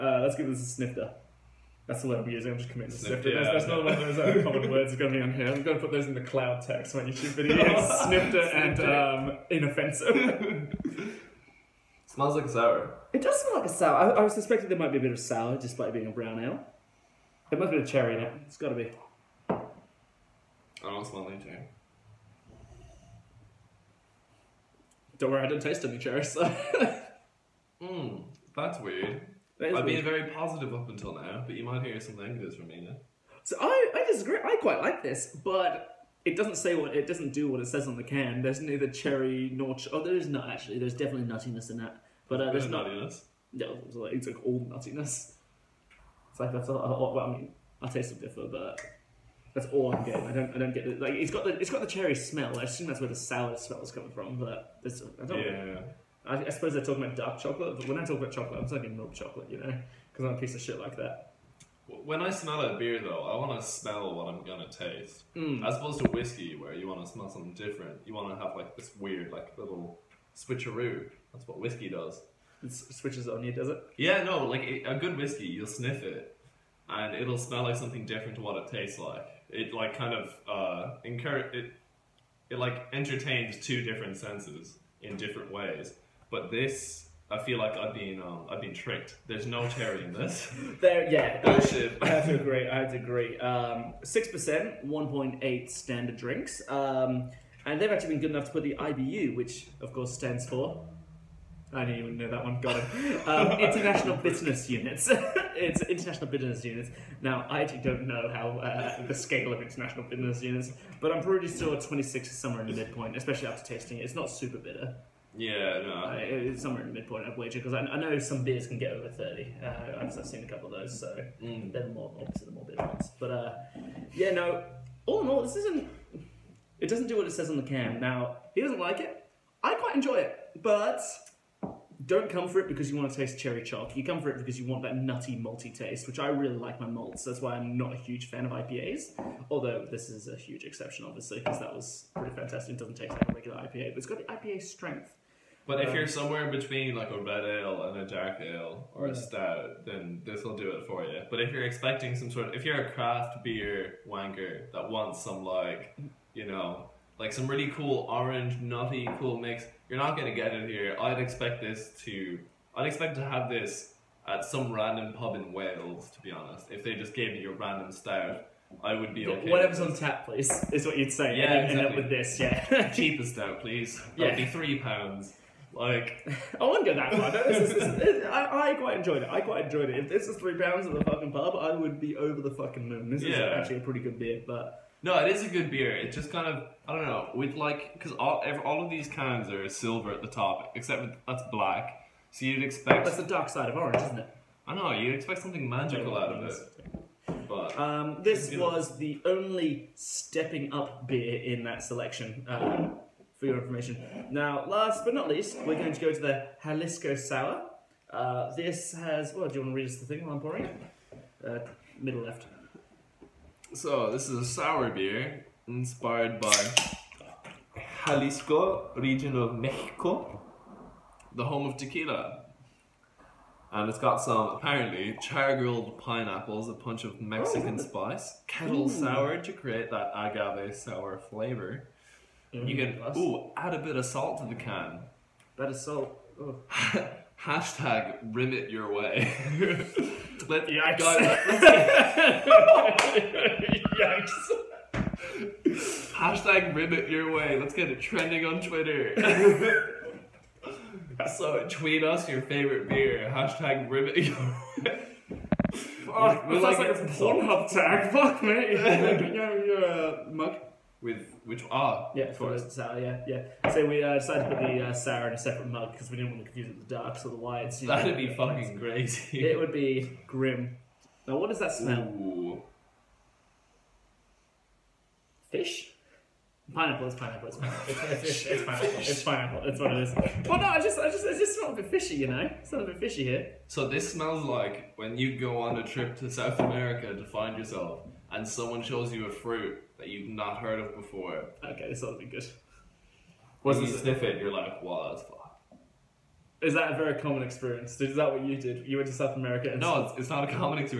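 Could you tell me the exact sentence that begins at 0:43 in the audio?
No, it's like, it's like all nuttiness.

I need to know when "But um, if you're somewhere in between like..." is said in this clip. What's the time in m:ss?
2:25.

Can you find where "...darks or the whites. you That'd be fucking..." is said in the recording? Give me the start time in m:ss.
4:26.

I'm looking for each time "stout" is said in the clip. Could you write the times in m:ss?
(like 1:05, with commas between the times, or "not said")
2:29, 2:47, 2:53.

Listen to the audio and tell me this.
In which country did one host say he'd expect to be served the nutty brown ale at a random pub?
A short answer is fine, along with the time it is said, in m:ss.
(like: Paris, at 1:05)
Wales, at 2:45.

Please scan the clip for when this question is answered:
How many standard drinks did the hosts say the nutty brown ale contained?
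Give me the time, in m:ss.
1:34.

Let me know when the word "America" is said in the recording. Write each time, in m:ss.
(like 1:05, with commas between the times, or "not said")
4:46, 4:59.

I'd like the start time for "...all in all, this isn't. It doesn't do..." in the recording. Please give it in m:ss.
2:05.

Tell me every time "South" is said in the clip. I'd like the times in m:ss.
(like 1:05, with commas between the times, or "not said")
4:46, 4:59.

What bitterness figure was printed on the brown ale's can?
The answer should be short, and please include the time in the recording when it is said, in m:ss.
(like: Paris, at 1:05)
26, at 1:51.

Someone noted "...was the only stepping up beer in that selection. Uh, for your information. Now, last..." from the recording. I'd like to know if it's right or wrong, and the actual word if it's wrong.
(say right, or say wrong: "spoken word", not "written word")
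right.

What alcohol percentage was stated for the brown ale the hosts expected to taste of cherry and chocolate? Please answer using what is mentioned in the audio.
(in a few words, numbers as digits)
6%.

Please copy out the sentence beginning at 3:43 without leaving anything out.
And it's got some apparently char grilled pineapples, a punch of Mexican oh.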